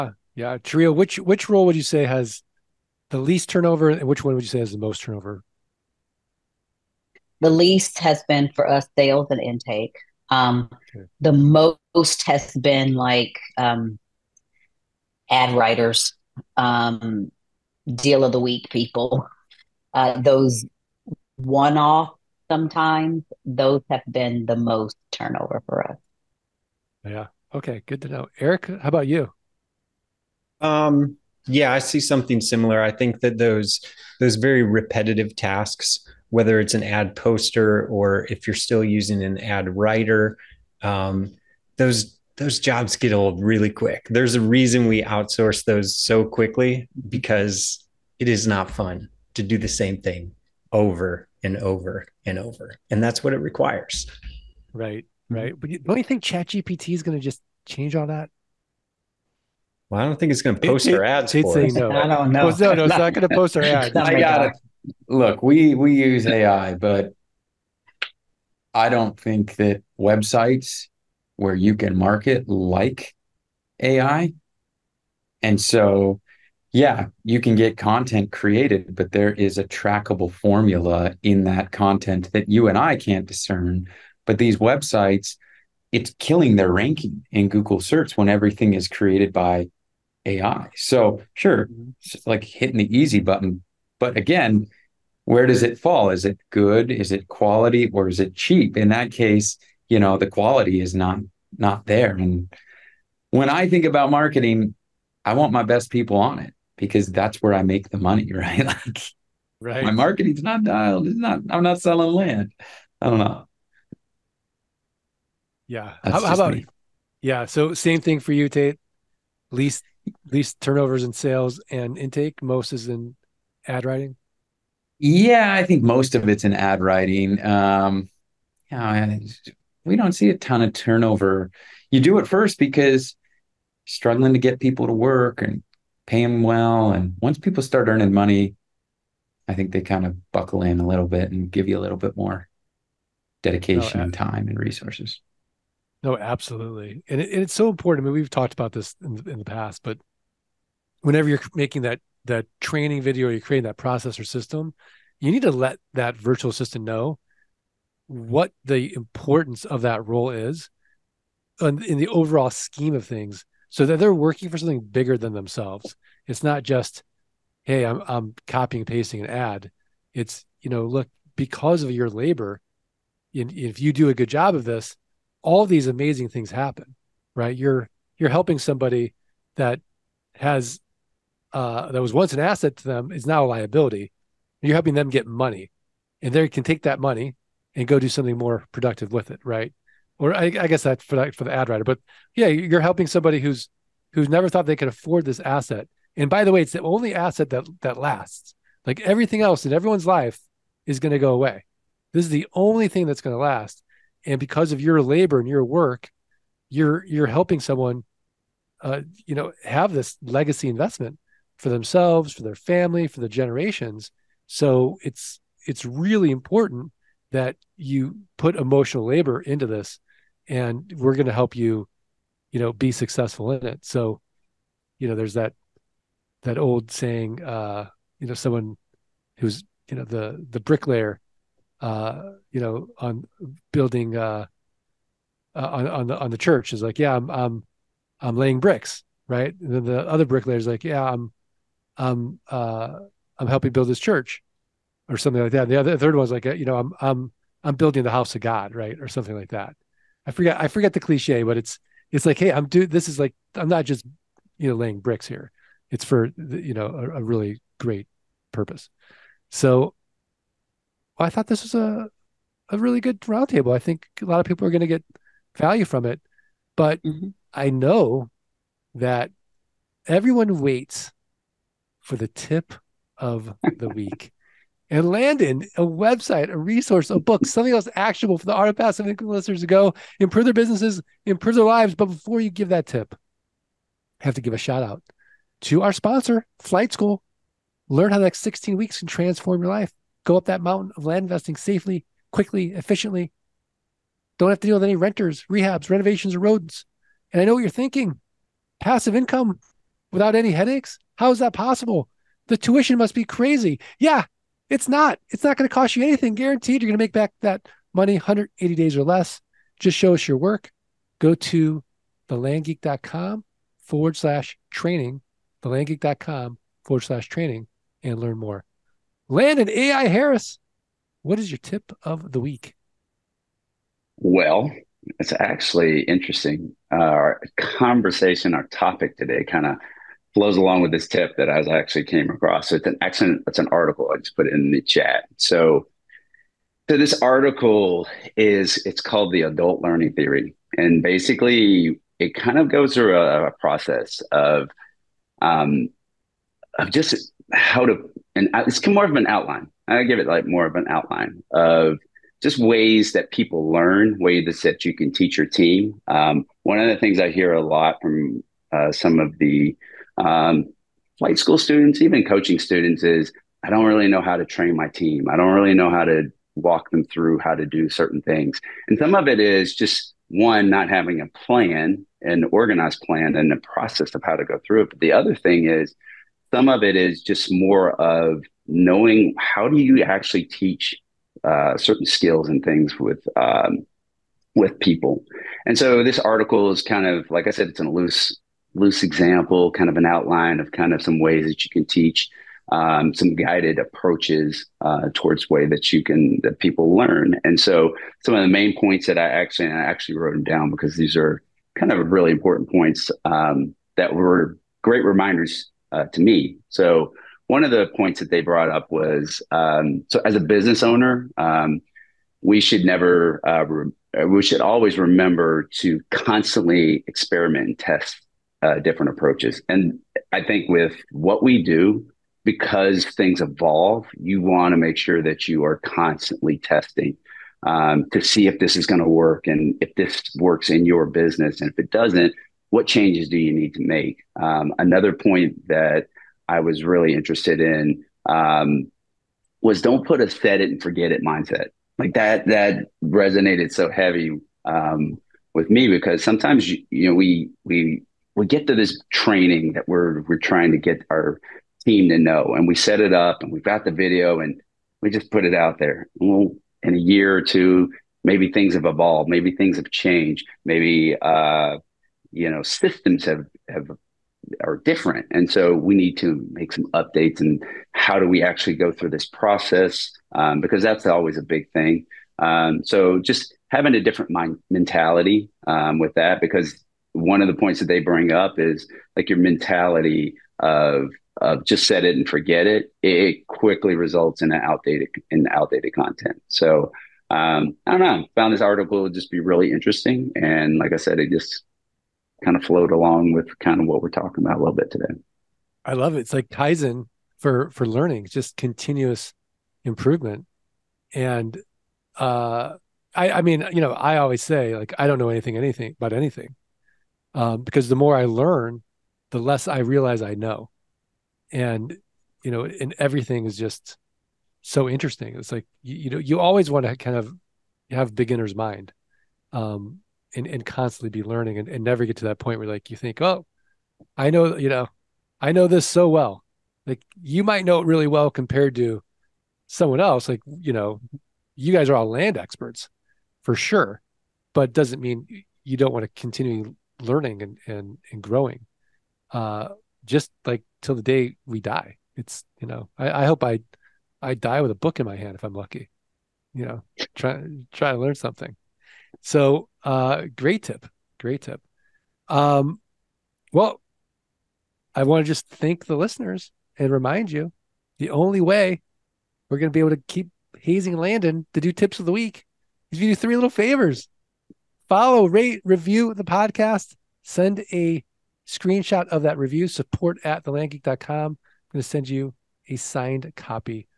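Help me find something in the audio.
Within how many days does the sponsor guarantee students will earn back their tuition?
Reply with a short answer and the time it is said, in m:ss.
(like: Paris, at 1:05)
180, at 5:08.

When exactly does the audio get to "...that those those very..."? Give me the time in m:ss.
0:33.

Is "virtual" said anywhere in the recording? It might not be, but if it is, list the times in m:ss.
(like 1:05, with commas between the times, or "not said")
2:36.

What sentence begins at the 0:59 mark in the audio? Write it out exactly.
Well, I don't think it's going to post our ads.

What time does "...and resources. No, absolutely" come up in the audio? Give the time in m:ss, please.
2:24.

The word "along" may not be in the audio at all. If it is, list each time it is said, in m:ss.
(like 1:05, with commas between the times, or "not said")
5:30, 8:12.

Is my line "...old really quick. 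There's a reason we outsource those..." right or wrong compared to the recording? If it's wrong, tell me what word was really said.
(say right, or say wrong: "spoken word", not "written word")
right.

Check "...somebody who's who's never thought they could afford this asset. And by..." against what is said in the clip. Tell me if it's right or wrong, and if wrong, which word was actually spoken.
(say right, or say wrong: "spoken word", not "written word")
right.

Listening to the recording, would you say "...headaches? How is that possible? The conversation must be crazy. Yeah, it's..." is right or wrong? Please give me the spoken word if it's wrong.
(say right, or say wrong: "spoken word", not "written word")
wrong: "tuition", not "conversation".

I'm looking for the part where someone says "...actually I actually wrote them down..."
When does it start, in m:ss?
6:39.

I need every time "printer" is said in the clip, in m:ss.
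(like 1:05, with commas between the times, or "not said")
not said.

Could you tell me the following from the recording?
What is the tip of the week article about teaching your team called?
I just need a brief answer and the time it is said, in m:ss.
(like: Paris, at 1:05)
adult learning theory, at 5:39.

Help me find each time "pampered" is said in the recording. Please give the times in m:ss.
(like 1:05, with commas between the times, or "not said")
not said.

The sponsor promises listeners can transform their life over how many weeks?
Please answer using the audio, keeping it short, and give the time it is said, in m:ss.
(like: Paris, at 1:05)
16, at 4:48.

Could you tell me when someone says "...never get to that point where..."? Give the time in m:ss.
8:41.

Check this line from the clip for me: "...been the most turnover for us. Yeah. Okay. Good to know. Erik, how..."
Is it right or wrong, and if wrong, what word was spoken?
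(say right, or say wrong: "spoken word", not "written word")
right.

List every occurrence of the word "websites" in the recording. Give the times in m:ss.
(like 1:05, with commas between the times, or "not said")
1:09, 1:24, 4:35.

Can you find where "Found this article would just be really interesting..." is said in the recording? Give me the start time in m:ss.
8:08.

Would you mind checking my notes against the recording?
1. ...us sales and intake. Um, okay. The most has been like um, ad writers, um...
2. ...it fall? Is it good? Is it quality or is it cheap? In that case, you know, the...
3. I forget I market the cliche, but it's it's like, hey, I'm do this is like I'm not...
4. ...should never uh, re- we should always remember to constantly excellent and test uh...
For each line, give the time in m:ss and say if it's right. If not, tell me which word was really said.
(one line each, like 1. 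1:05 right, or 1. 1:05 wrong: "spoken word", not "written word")
1. 0:08 right
2. 1:35 right
3. 4:10 wrong: "forget", not "market"
4. 6:52 wrong: "experiment", not "excellent".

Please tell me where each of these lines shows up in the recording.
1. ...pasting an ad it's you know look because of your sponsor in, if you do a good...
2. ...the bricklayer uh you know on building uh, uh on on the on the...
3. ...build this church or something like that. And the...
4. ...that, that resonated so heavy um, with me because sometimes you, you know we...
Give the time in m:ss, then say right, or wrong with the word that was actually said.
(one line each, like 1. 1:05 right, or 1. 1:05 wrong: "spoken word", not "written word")
1. 2:48 wrong: "labor", not "sponsor"
2. 3:50 right
3. 4:03 right
4. 7:22 right.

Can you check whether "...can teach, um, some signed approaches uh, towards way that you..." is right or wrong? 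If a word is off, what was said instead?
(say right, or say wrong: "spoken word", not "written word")
wrong: "guided", not "signed".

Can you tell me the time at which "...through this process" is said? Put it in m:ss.
7:48.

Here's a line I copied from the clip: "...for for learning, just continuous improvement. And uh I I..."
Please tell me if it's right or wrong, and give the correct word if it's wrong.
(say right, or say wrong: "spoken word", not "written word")
right.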